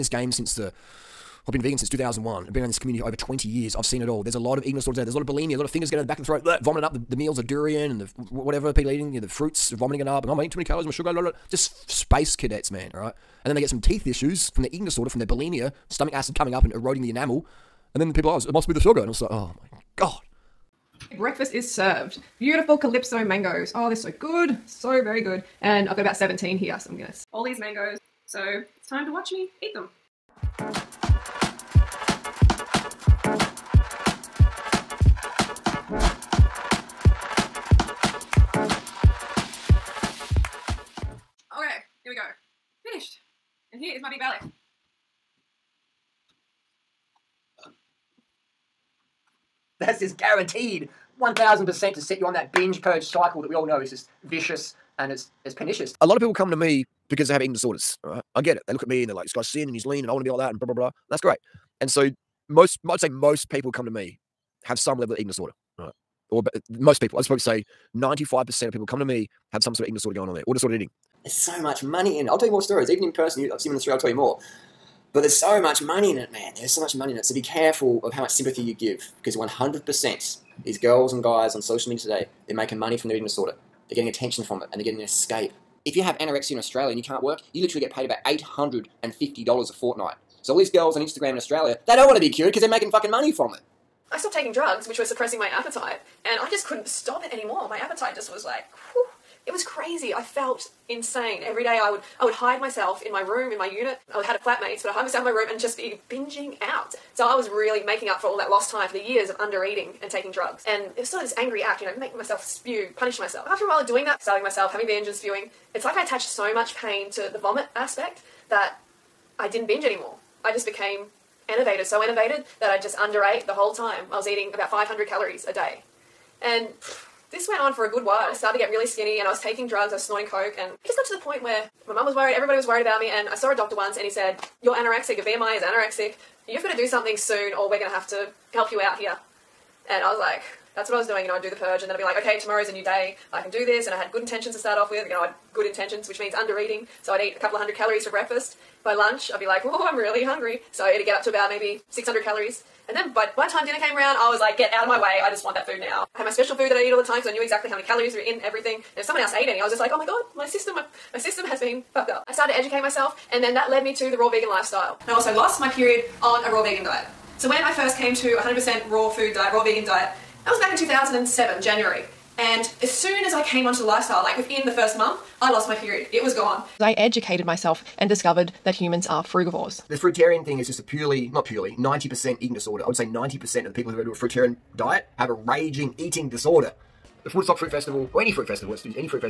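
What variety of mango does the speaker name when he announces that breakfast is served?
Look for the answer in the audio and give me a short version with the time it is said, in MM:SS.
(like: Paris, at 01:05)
Calypso, at 00:22.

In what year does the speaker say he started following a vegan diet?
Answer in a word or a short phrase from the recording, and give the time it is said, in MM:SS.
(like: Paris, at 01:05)
2001, at 00:01.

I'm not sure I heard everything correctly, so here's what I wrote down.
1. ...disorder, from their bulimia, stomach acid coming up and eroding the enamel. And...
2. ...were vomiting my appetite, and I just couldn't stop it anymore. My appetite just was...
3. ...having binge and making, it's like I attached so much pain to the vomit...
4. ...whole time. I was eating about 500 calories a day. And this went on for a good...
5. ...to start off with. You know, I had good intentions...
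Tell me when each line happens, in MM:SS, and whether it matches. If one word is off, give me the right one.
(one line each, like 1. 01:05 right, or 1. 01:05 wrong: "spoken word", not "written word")
1. 00:14 right
2. 01:34 wrong: "suppressing", not "vomiting"
3. 01:54 wrong: "spewing", not "making"
4. 02:03 right
5. 02:24 right.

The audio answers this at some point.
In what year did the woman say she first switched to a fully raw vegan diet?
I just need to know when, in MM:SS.
02:50.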